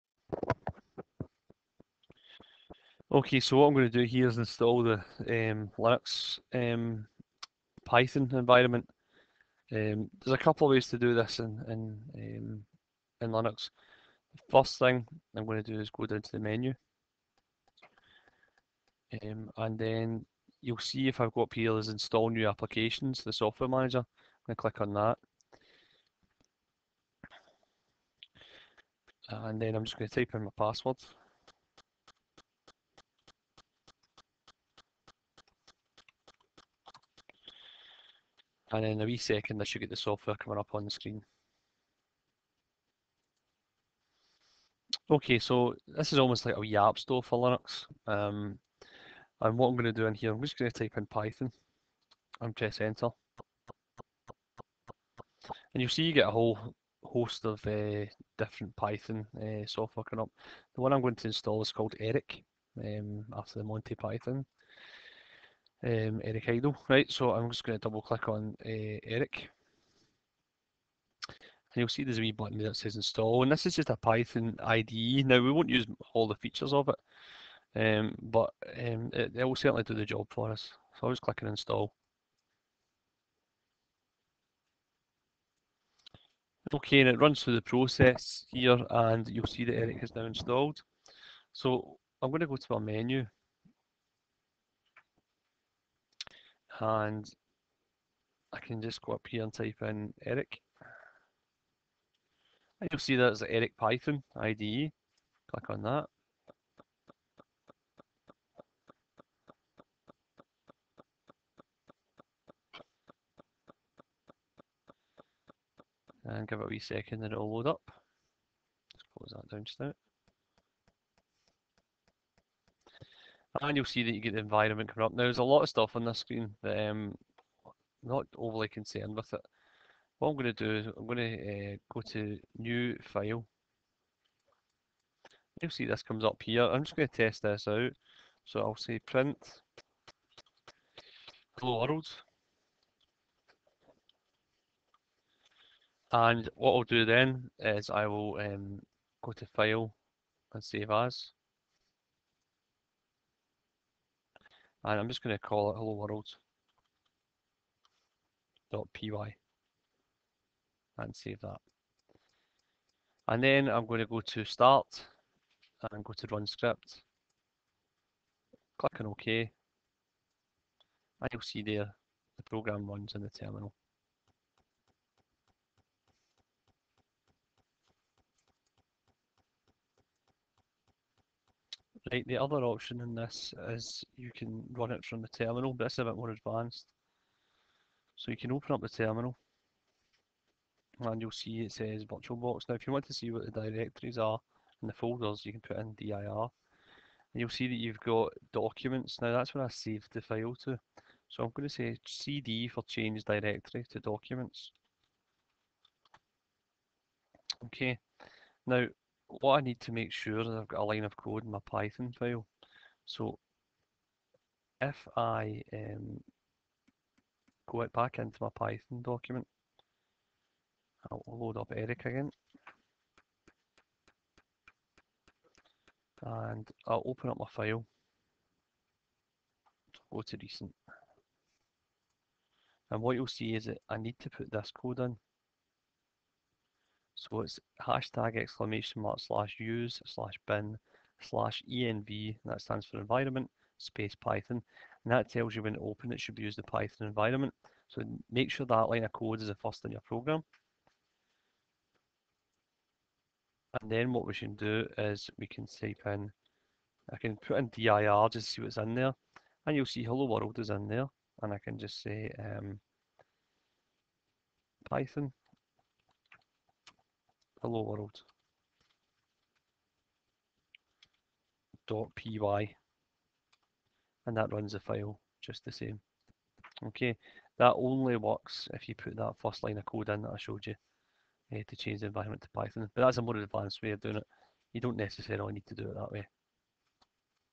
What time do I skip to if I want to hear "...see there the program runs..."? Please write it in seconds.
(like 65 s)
171 s.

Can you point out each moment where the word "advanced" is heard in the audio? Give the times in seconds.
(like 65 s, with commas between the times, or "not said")
186 s, 283 s.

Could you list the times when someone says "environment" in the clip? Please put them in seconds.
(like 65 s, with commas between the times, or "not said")
8 s, 124 s, 242 s, 247 s, 282 s.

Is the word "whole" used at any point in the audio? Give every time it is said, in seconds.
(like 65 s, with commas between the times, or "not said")
56 s.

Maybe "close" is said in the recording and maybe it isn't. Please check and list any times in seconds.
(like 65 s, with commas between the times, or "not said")
119 s.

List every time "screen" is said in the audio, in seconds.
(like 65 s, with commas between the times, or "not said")
40 s, 126 s.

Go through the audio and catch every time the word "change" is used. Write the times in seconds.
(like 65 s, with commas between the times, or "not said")
202 s, 281 s.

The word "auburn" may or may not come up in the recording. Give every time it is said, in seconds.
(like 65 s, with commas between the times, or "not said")
not said.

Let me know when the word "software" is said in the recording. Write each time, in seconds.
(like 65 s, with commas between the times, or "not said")
23 s, 39 s, 59 s.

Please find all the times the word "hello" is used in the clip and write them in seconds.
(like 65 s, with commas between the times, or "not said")
141 s, 155 s, 260 s, 267 s.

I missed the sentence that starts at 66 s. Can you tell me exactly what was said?
Right, so I'm just going to double click on uh, Eric.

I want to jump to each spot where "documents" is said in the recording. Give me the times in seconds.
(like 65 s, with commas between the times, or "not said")
198 s, 203 s, 219 s.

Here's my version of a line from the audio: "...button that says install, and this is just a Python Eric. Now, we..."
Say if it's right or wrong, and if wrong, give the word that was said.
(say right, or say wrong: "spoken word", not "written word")
wrong: "IDE", not "Eric".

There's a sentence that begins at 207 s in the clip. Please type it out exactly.
Okay, now what I need to make sure is I've got a line of code in my Python file.